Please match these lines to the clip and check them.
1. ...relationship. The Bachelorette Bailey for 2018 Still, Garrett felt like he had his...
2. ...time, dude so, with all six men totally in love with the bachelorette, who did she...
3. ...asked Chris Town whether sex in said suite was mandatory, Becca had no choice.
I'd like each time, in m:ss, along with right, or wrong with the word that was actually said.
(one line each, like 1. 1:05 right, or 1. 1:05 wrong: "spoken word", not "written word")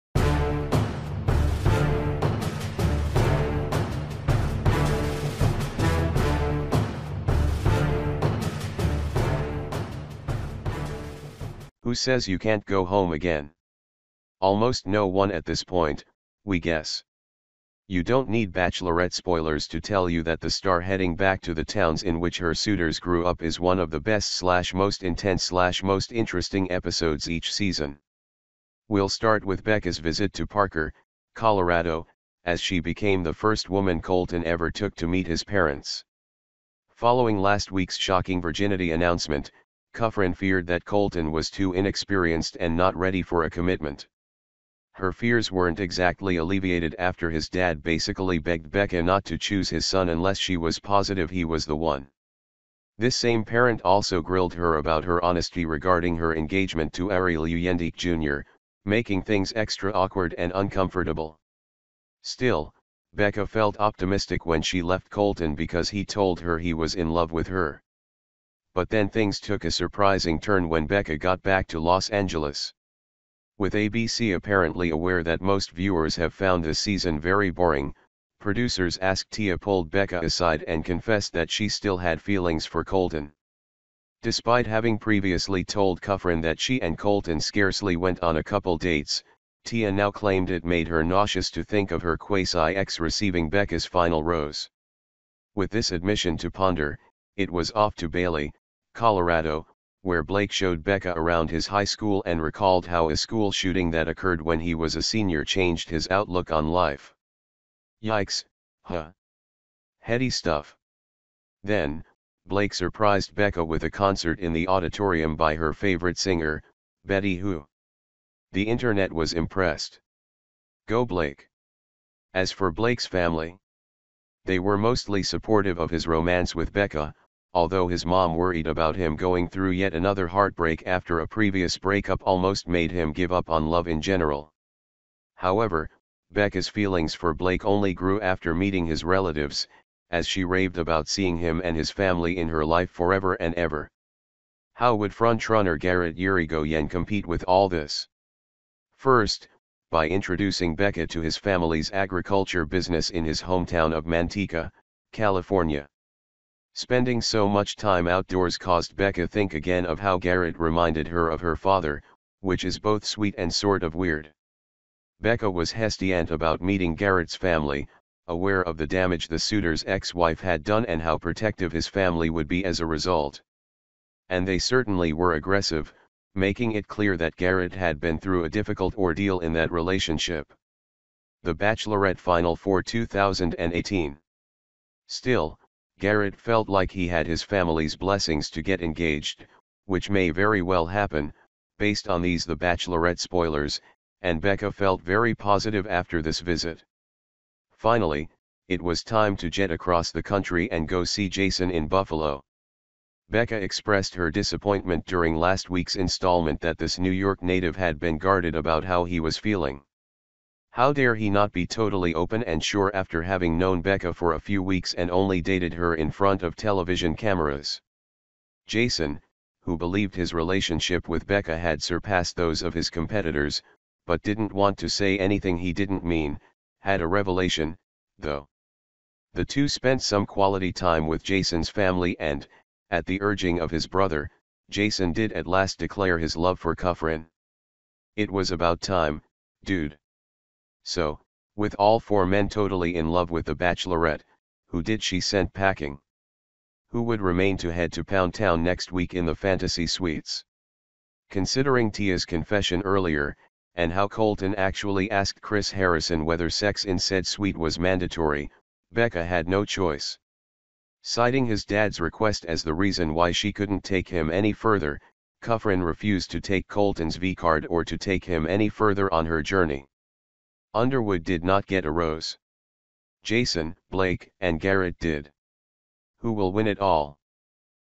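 1. 2:59 wrong: "Final", not "Bailey"
2. 3:58 wrong: "four", not "six"
3. 4:15 wrong: "Harrison", not "Town".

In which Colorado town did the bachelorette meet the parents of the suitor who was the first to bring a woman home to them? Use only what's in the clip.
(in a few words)
Parker, Colorado.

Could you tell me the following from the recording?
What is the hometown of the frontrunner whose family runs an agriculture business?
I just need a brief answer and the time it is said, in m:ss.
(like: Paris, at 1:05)
Manteca, California, at 2:34.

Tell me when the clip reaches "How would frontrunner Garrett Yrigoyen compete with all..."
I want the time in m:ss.
2:24.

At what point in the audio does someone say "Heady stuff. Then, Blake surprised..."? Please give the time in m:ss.
1:49.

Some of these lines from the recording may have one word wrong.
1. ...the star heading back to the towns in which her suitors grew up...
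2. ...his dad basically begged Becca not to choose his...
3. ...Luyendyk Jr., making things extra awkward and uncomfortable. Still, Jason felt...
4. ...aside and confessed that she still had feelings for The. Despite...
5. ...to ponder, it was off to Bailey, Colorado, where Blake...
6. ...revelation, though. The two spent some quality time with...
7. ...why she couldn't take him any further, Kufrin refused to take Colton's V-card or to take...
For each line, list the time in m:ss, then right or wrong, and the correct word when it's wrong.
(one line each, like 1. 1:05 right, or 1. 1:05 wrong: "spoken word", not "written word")
1. 0:20 right
2. 0:47 right
3. 0:57 wrong: "Becca", not "Jason"
4. 1:20 wrong: "Colton", not "The"
5. 1:36 right
6. 3:47 right
7. 4:23 right.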